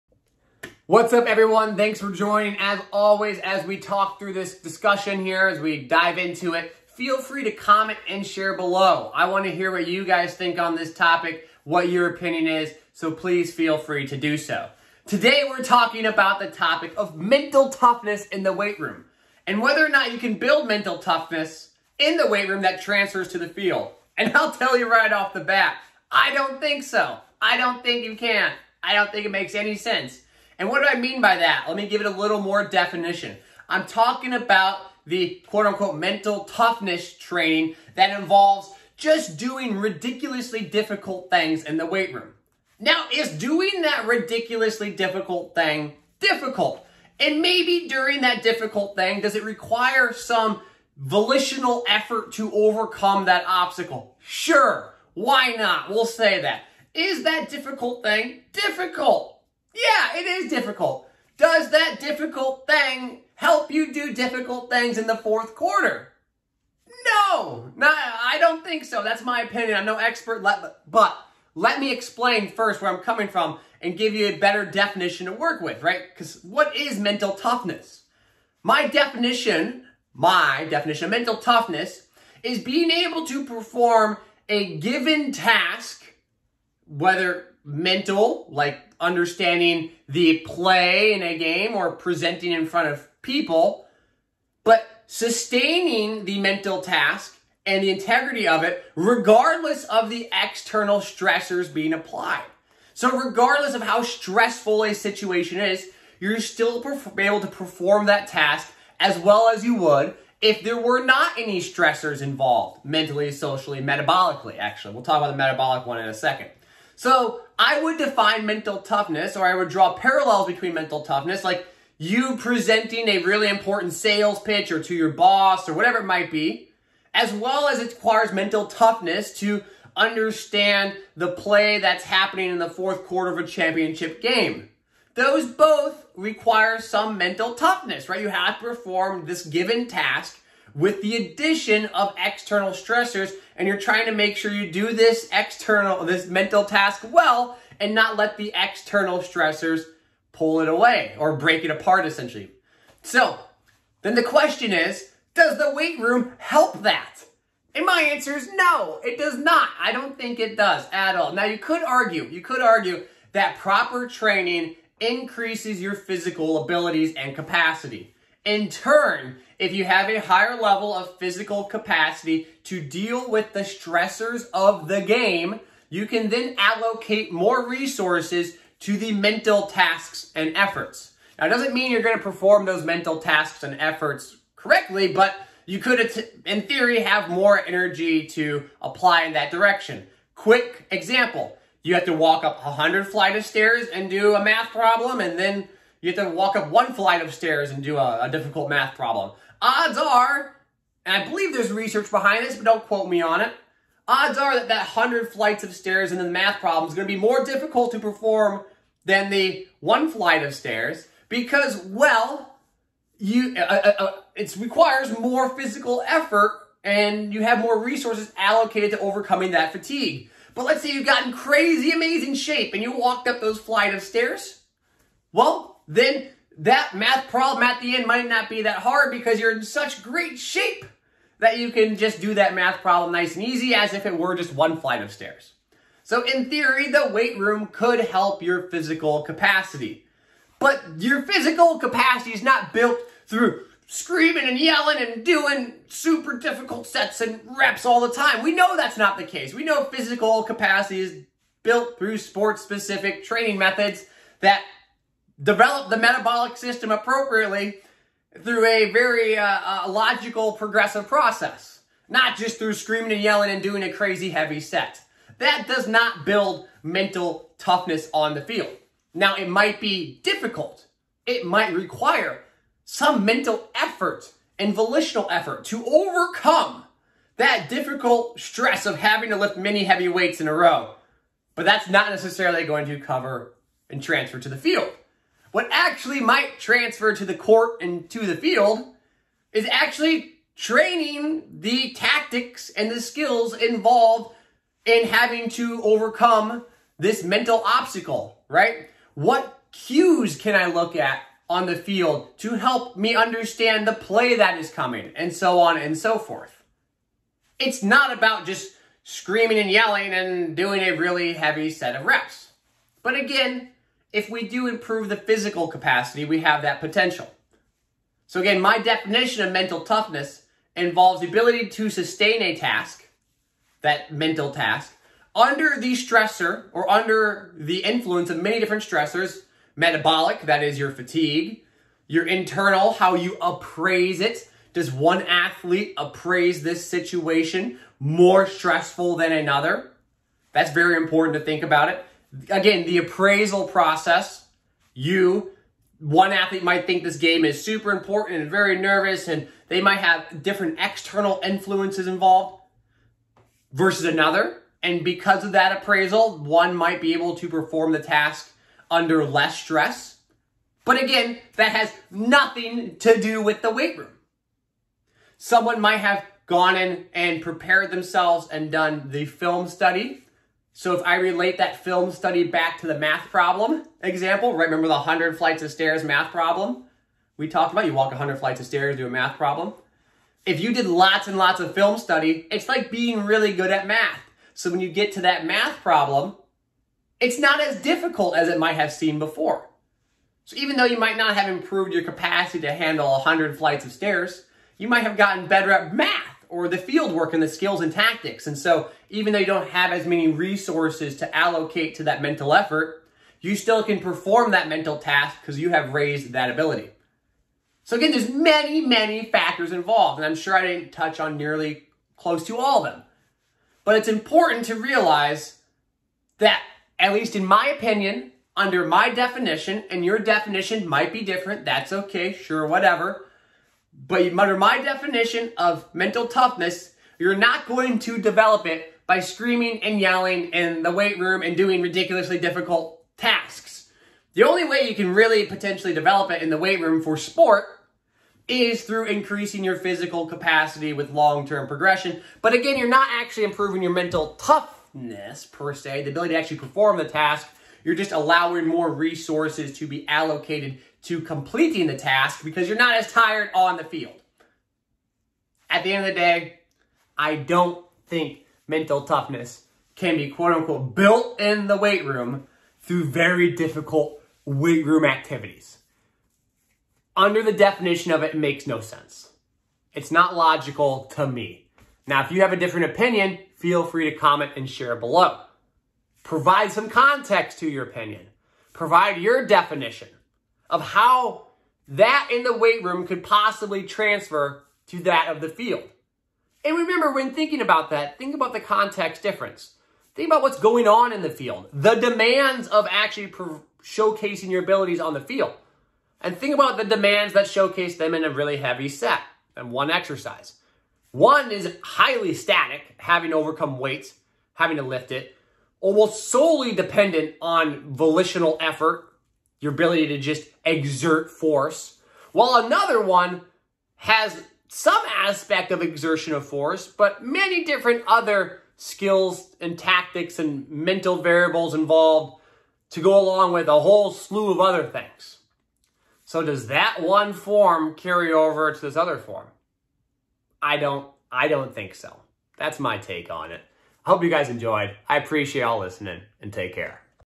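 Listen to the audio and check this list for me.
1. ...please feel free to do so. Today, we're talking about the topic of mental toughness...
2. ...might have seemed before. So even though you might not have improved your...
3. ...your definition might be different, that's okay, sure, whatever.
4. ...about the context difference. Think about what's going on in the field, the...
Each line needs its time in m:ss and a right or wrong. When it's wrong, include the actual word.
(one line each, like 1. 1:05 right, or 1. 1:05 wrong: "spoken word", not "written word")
1. 0:13 right
2. 6:28 right
3. 7:00 right
4. 8:08 right.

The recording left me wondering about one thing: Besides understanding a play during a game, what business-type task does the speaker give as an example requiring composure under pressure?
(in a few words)
Sales pitch.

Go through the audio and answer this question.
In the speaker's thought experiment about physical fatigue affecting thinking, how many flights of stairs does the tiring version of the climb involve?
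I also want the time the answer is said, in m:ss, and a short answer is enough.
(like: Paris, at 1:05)
100, at 3:12.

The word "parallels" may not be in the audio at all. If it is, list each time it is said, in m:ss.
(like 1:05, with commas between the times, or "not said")
1:59.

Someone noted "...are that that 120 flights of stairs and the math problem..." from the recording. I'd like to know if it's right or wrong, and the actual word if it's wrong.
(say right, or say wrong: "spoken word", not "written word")
wrong: "100", not "120".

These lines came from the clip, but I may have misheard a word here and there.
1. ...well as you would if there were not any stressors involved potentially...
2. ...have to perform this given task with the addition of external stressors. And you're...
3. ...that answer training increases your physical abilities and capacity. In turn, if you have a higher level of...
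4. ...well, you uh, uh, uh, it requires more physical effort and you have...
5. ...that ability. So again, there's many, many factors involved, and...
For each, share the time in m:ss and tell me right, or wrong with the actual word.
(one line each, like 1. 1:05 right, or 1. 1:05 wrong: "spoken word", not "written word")
1. 1:49 wrong: "mentally", not "potentially"
2. 2:18 right
3. 2:43 wrong: "proper", not "answer"
4. 3:31 right
5. 6:46 right.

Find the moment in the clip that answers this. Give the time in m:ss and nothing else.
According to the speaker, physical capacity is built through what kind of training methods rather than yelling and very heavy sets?
4:12.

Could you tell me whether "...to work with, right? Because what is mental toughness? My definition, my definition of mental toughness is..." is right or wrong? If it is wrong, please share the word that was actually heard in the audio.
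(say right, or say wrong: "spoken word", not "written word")
right.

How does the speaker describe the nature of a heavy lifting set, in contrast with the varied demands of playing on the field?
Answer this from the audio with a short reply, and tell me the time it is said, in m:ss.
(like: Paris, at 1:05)
Highly static, at 8:21.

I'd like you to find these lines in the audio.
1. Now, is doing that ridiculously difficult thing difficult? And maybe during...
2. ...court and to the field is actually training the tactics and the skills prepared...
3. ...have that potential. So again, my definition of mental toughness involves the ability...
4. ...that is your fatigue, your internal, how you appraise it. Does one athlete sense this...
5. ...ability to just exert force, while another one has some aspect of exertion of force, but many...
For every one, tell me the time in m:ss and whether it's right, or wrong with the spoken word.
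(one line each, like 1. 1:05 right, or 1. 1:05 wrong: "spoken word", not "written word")
1. 0:42 right
2. 4:47 wrong: "involved", not "prepared"
3. 5:16 right
4. 5:30 wrong: "appraise", not "sense"
5. 8:29 right.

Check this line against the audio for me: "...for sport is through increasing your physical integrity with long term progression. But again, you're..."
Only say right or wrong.
wrong.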